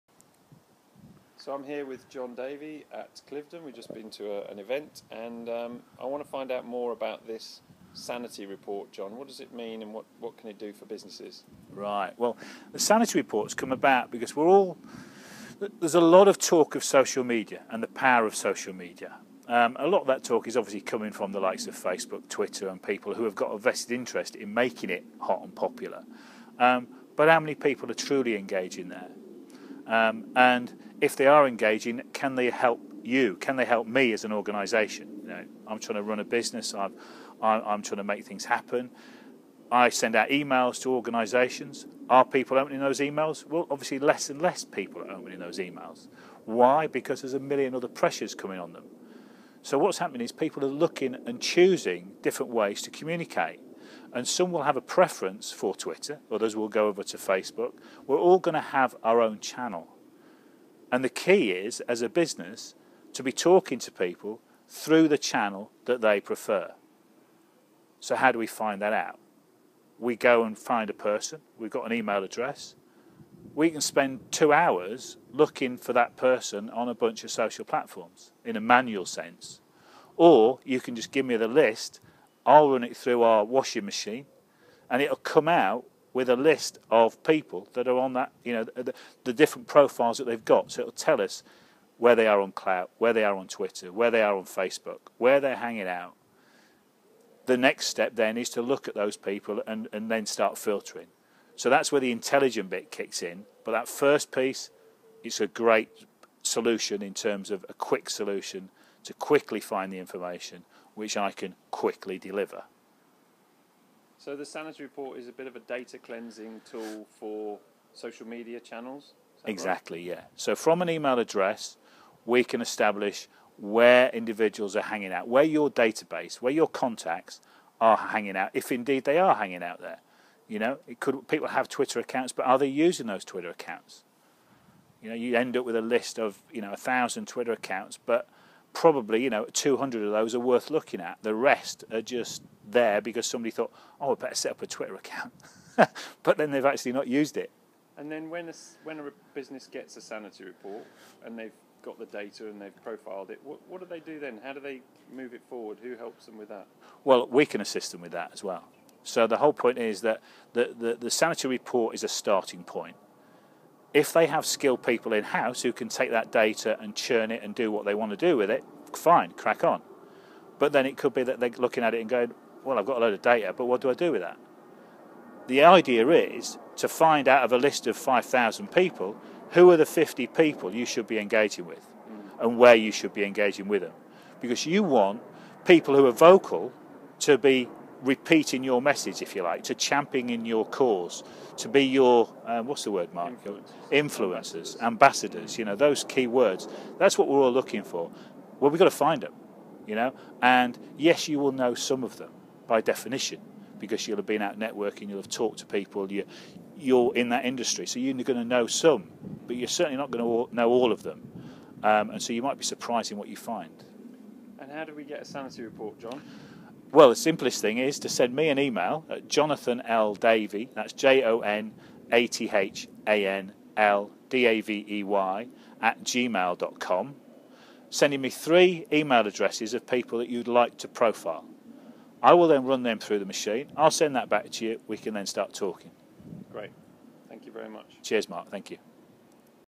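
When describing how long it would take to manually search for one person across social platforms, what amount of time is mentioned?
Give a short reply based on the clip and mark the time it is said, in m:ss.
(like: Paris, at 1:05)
2 hours, at 1:14.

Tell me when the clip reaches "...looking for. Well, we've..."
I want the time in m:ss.
3:17.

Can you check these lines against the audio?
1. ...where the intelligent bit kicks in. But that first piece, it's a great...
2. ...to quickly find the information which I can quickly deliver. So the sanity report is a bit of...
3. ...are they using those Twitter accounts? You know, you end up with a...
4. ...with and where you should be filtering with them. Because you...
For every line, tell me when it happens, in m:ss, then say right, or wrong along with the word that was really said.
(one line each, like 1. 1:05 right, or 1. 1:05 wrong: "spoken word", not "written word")
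1. 1:41 right
2. 1:49 right
3. 2:12 right
4. 3:01 wrong: "engaging", not "filtering".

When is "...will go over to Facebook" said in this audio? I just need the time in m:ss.
0:56.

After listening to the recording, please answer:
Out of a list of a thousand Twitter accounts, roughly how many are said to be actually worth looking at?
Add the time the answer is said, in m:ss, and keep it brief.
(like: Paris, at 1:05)
200, at 2:19.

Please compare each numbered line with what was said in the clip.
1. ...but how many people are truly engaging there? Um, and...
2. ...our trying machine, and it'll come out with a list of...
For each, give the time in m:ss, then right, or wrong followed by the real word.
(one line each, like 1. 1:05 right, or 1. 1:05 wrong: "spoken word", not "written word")
1. 0:27 right
2. 1:23 wrong: "washing", not "trying".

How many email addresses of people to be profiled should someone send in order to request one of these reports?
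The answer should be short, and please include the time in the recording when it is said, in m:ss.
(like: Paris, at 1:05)
3, at 3:48.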